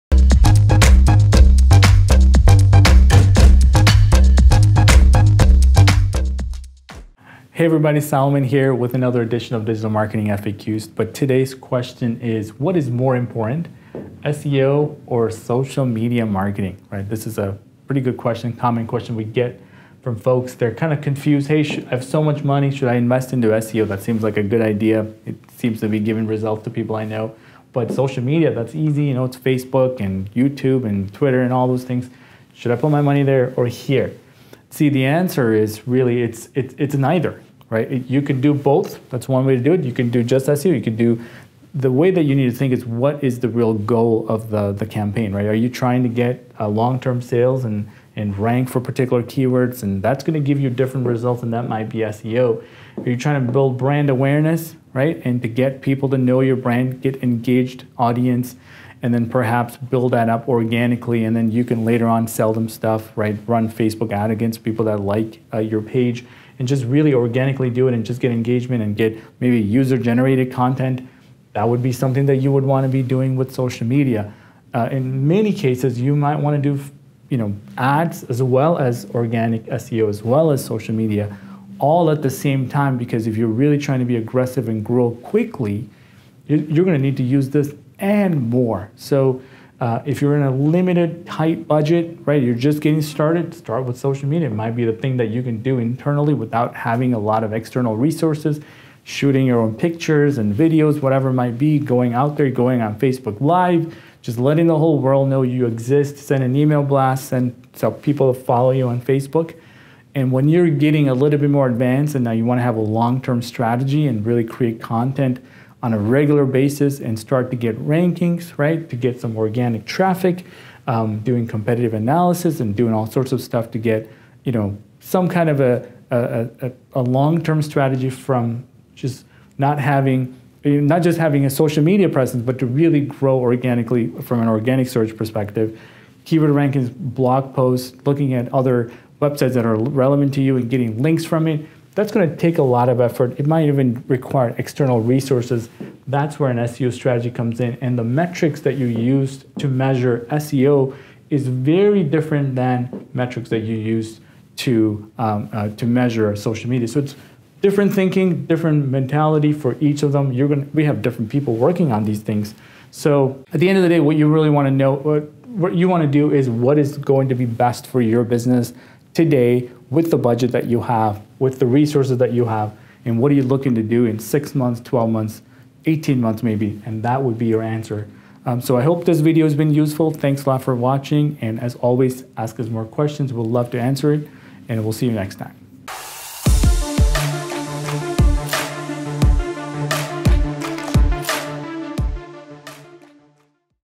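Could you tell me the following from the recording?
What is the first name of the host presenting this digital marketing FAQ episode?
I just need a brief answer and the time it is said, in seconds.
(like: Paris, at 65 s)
Solomon, at 8 s.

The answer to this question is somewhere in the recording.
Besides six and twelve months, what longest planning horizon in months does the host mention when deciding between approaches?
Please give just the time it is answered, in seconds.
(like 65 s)
175 s.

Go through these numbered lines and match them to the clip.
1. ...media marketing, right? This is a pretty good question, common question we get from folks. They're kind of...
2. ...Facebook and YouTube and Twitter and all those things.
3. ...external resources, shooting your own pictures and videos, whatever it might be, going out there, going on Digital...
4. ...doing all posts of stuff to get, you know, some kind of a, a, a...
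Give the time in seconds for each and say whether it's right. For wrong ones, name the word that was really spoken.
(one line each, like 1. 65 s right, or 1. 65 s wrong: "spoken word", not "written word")
1. 15 s right
2. 29 s right
3. 97 s wrong: "Facebook", not "Digital"
4. 122 s wrong: "sorts", not "posts".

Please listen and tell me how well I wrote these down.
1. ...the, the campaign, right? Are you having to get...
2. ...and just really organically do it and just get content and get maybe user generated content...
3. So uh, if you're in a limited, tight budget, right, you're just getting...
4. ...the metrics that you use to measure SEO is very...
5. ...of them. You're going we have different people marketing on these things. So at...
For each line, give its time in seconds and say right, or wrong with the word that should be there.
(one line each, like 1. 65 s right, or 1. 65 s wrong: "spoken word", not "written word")
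1. 44 s wrong: "trying", not "having"
2. 66 s wrong: "engagement", not "content"
3. 88 s right
4. 147 s right
5. 160 s wrong: "working", not "marketing".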